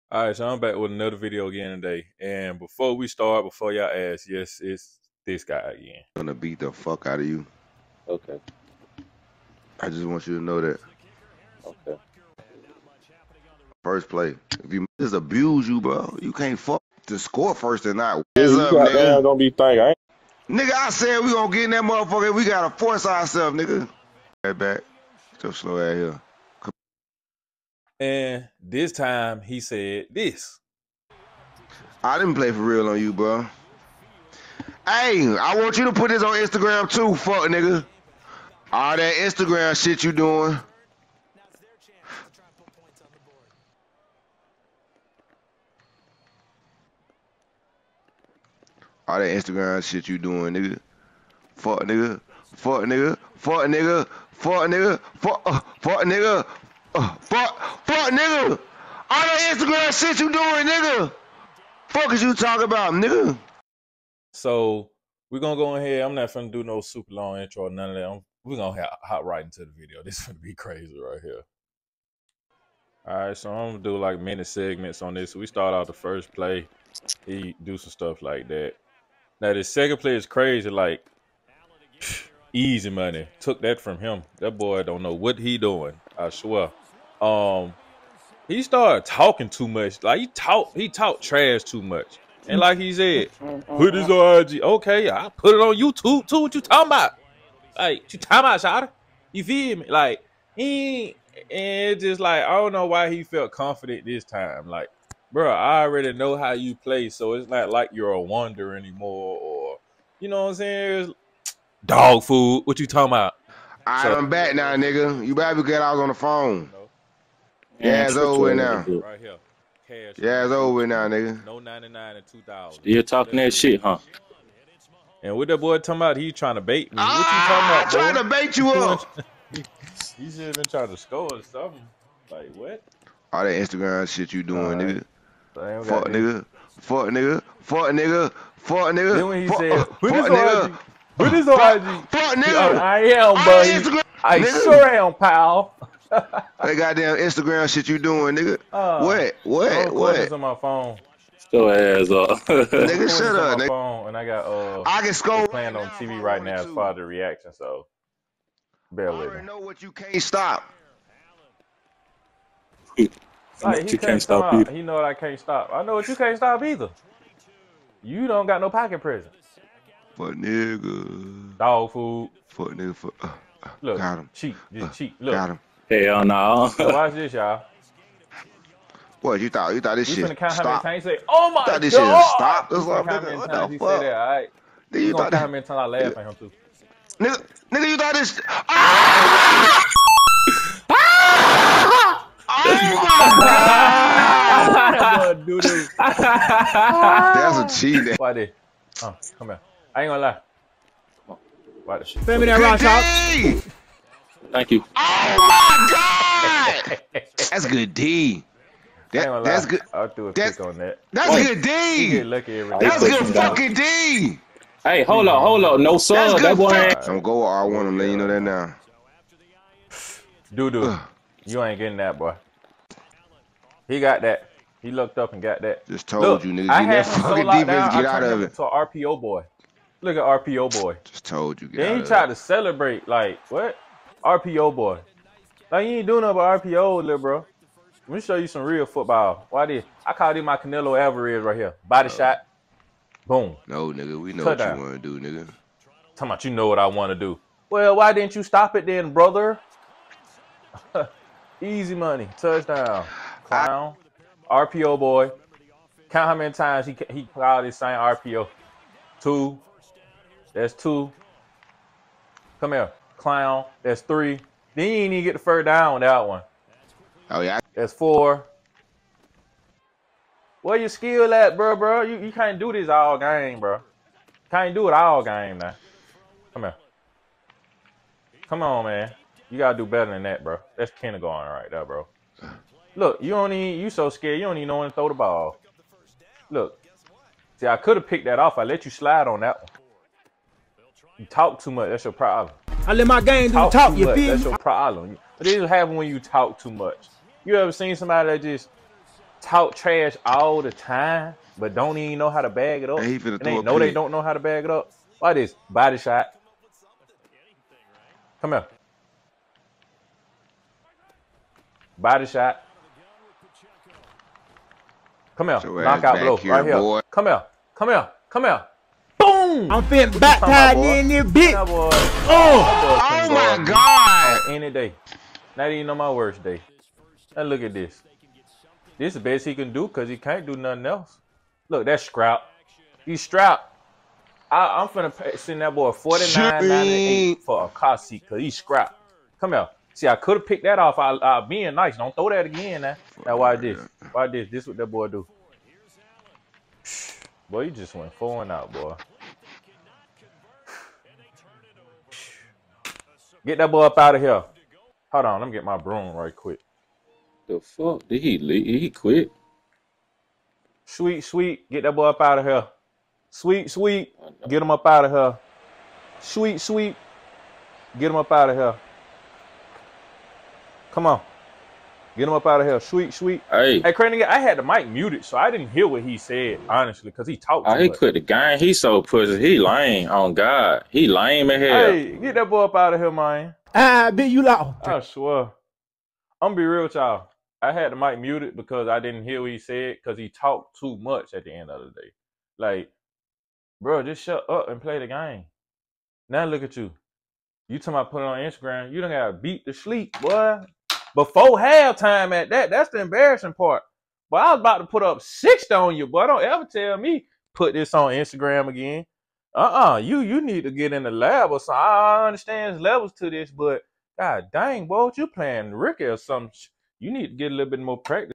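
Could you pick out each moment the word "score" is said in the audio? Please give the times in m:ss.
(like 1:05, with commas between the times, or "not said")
0:17, 2:10, 2:35.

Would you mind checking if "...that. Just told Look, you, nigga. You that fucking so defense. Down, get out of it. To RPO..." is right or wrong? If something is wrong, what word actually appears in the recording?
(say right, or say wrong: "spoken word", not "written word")
right.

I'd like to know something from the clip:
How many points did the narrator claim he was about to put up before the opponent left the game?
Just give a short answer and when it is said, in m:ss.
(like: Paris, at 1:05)
60, at 6:45.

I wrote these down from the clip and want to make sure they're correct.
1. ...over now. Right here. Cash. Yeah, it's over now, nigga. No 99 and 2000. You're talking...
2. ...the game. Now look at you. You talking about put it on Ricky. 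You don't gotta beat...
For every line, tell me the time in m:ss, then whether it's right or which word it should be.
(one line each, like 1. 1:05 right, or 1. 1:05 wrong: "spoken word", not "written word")
1. 1:58 right
2. 6:34 wrong: "Instagram", not "Ricky".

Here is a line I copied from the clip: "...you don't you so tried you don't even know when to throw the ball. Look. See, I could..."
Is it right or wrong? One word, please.
wrong.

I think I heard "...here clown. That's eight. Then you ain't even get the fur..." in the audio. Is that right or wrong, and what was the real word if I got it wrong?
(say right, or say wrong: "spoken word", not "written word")
wrong: "three", not "eight".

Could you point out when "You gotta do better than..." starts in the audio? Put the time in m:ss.
4:39.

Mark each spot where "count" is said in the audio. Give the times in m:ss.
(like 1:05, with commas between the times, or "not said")
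3:00, 4:16.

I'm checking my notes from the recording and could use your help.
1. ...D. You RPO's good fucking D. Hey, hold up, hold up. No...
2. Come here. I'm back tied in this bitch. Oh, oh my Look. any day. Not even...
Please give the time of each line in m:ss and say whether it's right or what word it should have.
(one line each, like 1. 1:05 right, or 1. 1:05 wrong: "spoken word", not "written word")
1. 3:31 wrong: "That", not "RPO"
2. 5:18 wrong: "God", not "Look".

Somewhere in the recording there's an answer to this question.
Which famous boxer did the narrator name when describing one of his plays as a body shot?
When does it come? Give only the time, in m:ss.
4:00.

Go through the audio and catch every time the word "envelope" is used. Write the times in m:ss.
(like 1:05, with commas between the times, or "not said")
not said.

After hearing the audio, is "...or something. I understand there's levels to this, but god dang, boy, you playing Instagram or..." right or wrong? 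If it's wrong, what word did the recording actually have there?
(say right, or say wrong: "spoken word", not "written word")
wrong: "Ricky", not "Instagram".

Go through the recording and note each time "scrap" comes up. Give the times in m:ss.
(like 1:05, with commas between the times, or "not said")
5:32, 5:38.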